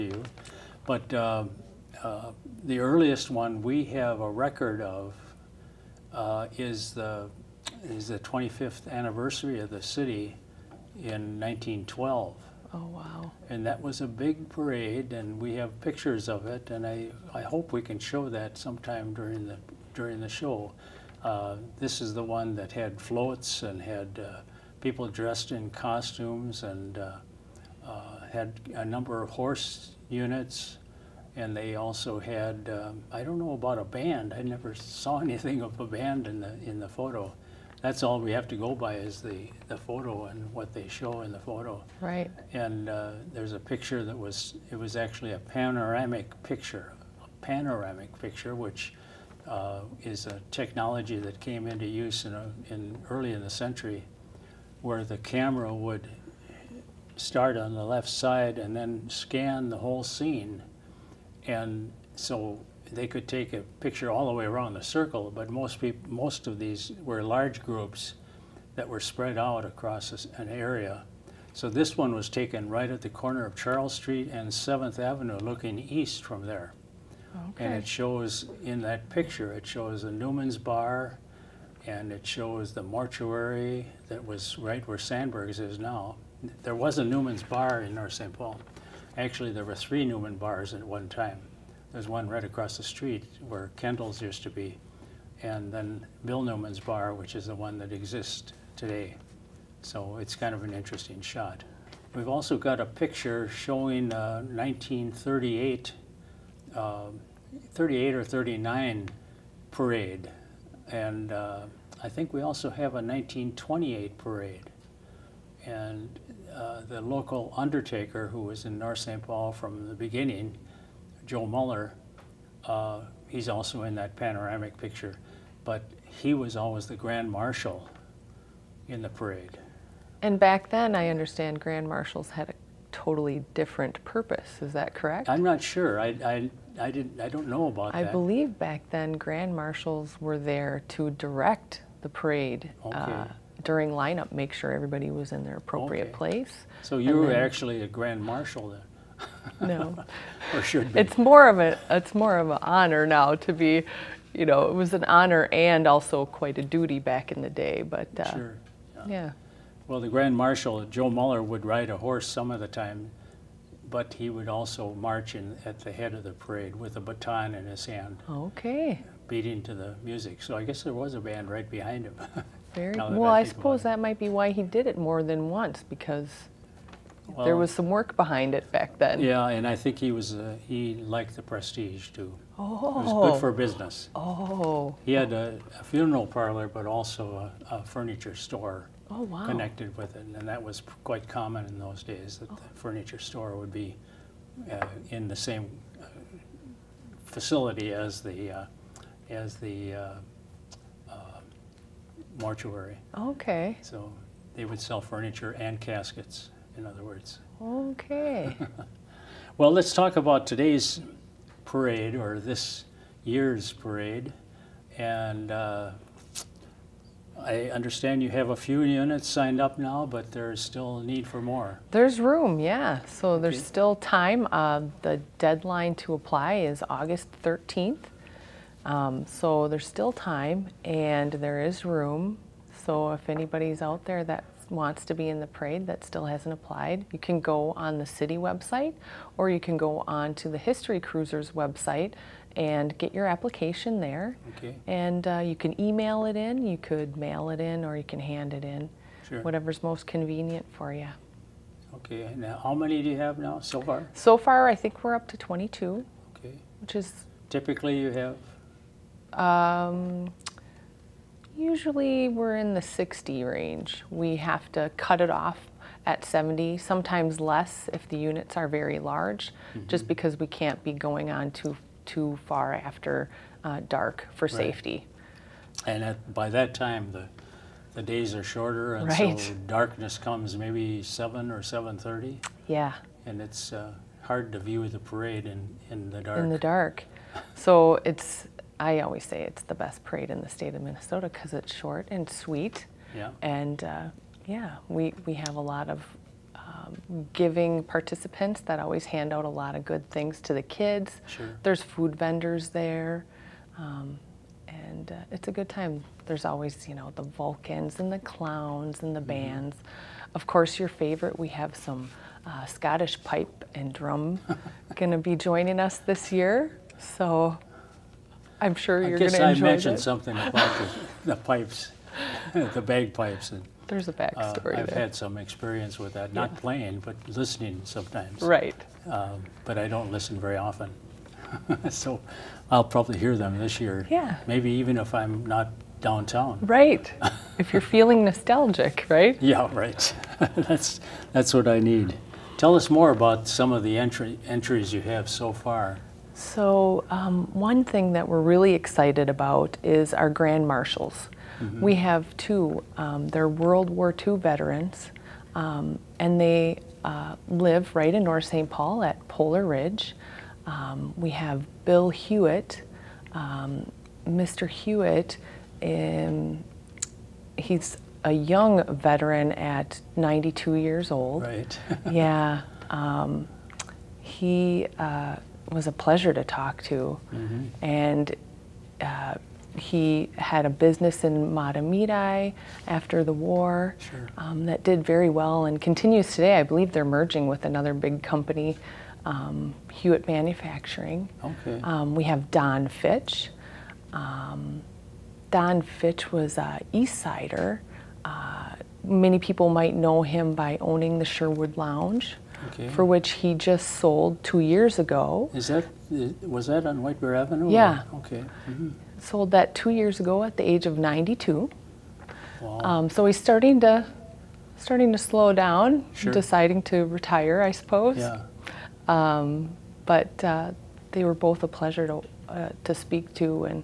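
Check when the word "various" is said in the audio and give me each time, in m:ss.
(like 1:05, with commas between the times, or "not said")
not said.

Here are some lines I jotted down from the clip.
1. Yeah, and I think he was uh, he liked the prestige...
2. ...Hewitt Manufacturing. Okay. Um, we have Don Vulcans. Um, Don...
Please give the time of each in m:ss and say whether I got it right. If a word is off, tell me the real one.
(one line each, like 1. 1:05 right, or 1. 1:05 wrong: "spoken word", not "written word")
1. 2:59 right
2. 6:29 wrong: "Fitch", not "Vulcans".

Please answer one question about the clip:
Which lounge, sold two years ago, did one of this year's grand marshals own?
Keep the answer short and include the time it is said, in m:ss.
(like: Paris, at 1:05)
Sherwood Lounge, at 6:41.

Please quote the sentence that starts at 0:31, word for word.
And they also had, um, I don't know about a band.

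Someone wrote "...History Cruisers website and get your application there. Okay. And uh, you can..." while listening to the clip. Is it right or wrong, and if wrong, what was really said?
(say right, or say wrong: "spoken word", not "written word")
right.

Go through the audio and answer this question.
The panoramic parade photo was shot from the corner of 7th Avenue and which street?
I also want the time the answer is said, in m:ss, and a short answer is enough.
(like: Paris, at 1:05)
Charles Street, at 1:13.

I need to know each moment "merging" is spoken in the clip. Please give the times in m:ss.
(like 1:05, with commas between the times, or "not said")
6:27.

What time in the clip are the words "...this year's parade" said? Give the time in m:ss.
3:32.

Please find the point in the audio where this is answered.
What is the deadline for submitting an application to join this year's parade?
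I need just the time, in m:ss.
3:46.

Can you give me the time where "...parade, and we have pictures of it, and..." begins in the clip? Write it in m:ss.
0:14.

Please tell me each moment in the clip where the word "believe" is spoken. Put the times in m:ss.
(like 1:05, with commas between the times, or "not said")
2:18, 6:26.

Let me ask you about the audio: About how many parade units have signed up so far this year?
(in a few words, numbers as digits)
22.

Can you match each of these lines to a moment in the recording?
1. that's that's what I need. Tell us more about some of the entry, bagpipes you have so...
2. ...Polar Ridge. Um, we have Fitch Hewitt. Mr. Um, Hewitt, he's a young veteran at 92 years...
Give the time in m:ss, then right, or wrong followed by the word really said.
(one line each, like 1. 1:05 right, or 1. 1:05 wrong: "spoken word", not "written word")
1. 5:40 wrong: "entries", not "bagpipes"
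2. 5:59 wrong: "Bill", not "Fitch".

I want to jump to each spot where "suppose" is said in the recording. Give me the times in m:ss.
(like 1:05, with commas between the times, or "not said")
2:53, 6:57.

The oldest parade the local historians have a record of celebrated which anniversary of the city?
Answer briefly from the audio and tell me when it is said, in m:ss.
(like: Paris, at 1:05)
25th, at 0:08.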